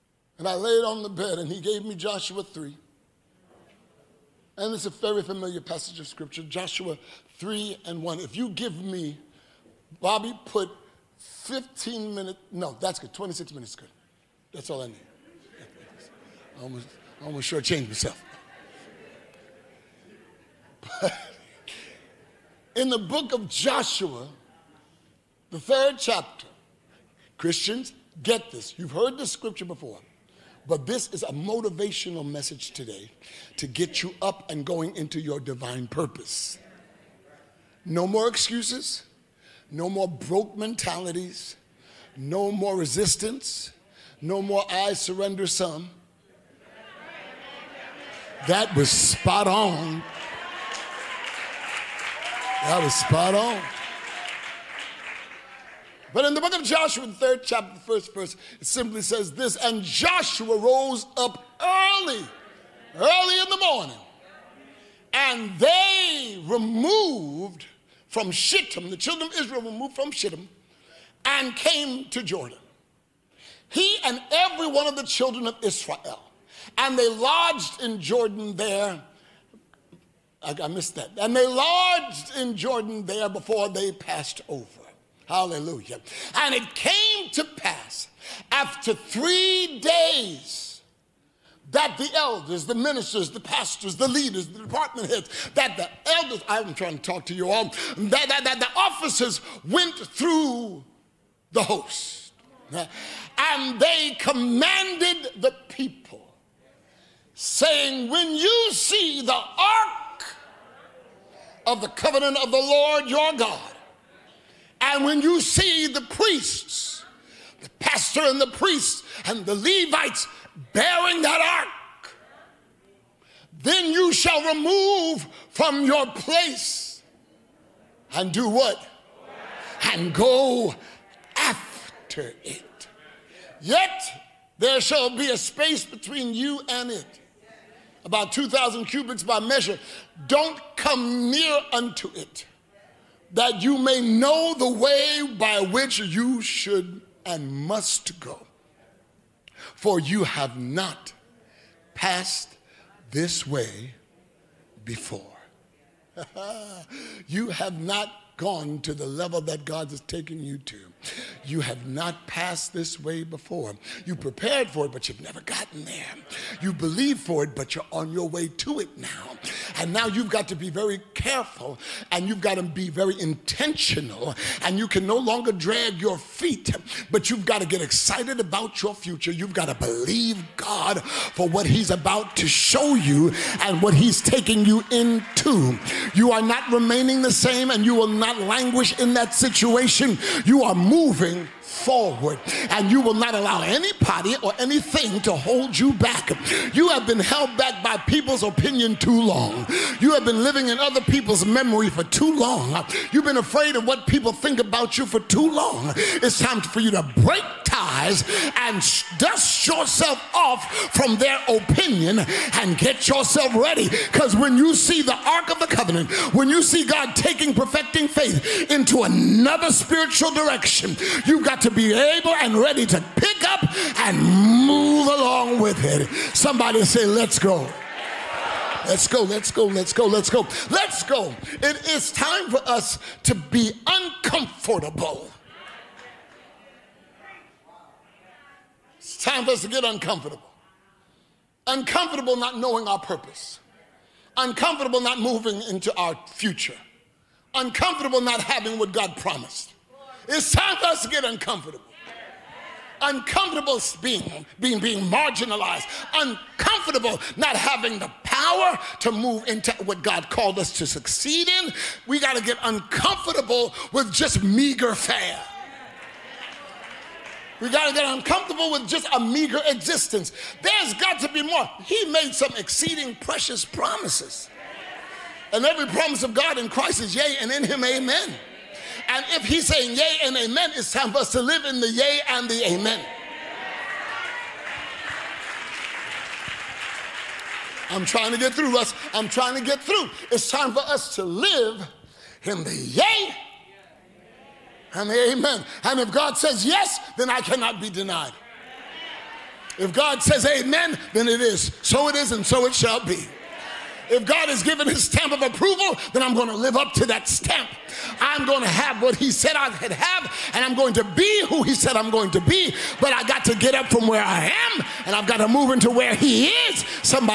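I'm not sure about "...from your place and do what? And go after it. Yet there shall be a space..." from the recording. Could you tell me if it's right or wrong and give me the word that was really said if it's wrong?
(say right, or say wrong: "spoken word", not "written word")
right.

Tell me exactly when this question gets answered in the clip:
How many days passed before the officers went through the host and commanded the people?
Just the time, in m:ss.
1:28.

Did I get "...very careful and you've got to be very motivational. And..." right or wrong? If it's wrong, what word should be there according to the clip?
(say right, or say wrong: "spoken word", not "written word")
wrong: "intentional", not "motivational".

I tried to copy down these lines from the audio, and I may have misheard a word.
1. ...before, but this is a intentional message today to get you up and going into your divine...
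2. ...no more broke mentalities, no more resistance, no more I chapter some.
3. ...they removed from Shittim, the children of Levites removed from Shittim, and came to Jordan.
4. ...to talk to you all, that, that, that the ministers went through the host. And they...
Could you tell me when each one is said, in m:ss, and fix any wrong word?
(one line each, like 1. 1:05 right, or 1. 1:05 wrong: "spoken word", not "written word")
1. 0:29 wrong: "motivational", not "intentional"
2. 0:39 wrong: "surrender", not "chapter"
3. 1:05 wrong: "Israel", not "Levites"
4. 1:36 wrong: "officers", not "ministers".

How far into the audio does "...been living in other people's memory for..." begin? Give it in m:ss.
3:20.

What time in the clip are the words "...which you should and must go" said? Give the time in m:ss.
2:25.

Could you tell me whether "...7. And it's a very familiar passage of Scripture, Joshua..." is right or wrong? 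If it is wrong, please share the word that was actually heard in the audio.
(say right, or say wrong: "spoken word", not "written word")
wrong: "3", not "7".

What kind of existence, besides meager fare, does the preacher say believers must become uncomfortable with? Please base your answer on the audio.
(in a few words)
meager existence.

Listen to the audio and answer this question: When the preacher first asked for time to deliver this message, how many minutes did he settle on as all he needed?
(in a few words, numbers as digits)
26.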